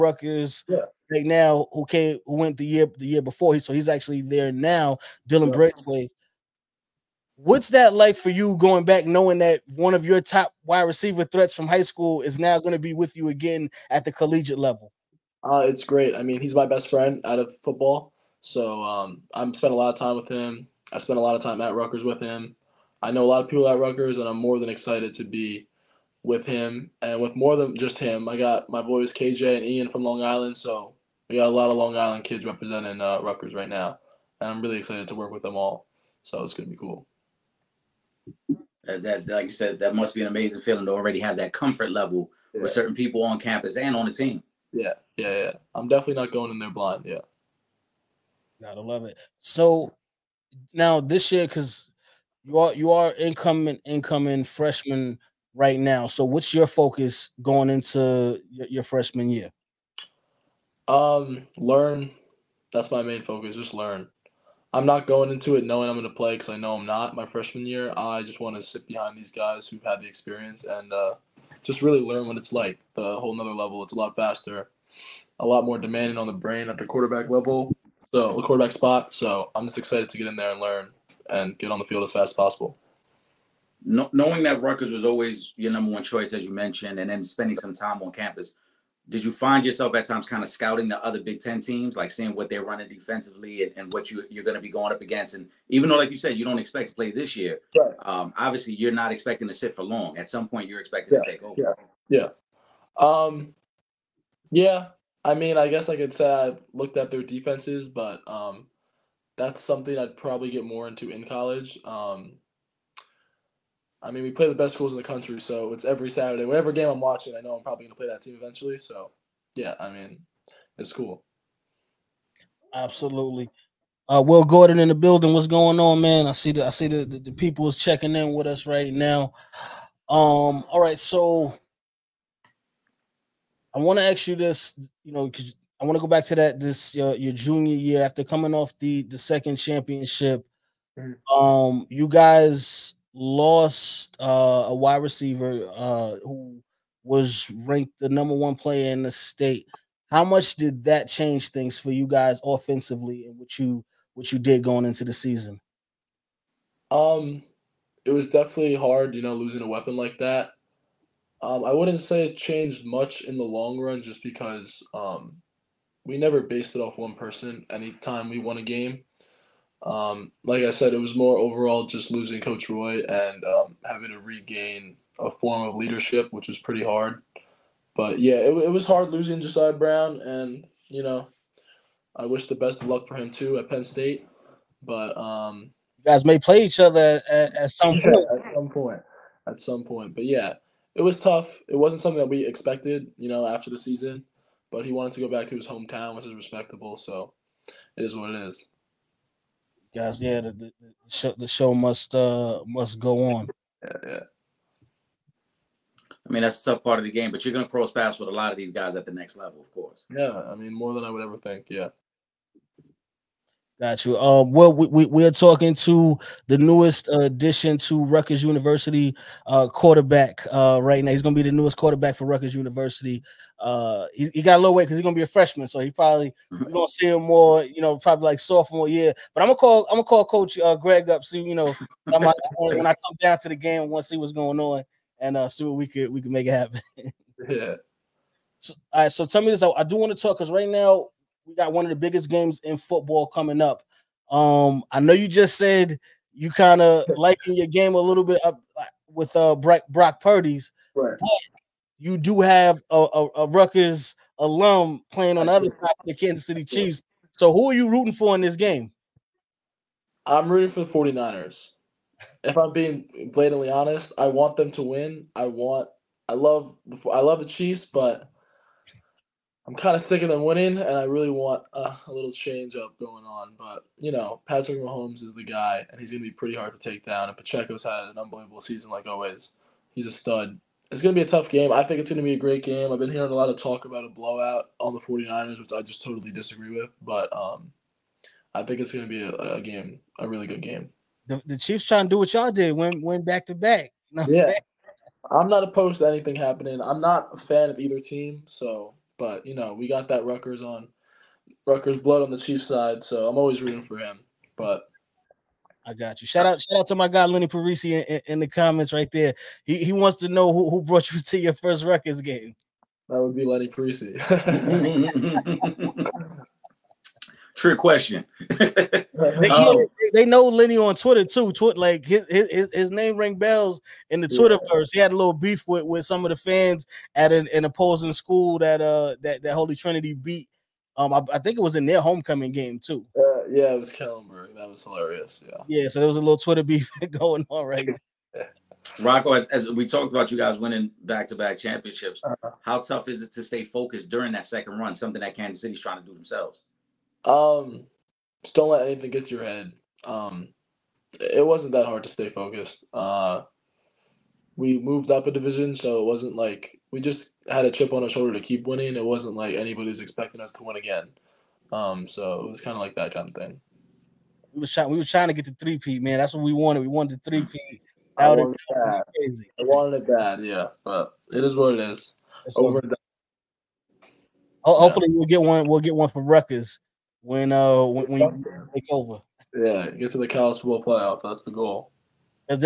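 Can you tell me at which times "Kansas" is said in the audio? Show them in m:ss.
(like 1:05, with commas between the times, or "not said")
4:16, 5:45.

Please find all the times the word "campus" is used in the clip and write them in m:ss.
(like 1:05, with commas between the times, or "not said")
0:43, 1:28.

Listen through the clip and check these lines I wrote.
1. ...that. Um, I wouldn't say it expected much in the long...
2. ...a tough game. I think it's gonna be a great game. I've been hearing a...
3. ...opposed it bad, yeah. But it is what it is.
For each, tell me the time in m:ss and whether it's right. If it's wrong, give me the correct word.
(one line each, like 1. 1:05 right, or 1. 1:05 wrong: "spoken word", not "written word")
1. 2:40 wrong: "changed", not "expected"
2. 4:41 right
3. 6:09 wrong: "wanted", not "opposed".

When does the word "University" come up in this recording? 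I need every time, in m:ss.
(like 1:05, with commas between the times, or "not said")
3:38, 3:42.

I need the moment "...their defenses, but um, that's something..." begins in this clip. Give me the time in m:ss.
1:47.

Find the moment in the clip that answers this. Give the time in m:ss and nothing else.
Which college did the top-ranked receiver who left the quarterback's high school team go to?
3:03.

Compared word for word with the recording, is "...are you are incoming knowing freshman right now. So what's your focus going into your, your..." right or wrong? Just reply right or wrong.
wrong.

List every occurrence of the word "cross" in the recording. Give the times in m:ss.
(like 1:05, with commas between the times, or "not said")
3:27.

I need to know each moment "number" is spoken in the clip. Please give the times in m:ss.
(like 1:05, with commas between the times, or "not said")
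1:25, 2:28.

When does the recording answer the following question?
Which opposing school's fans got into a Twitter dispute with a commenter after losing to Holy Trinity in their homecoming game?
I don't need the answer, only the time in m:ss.
5:33.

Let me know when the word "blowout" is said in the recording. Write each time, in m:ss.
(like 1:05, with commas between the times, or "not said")
4:44.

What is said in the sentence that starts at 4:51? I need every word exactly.
The, the, Chiefs trying to do what y'all did, went went back to back.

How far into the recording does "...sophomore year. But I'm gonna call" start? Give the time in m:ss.
3:48.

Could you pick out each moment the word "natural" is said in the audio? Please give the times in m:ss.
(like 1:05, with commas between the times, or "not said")
not said.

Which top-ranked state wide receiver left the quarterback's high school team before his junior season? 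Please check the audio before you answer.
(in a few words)
Josiah Brown.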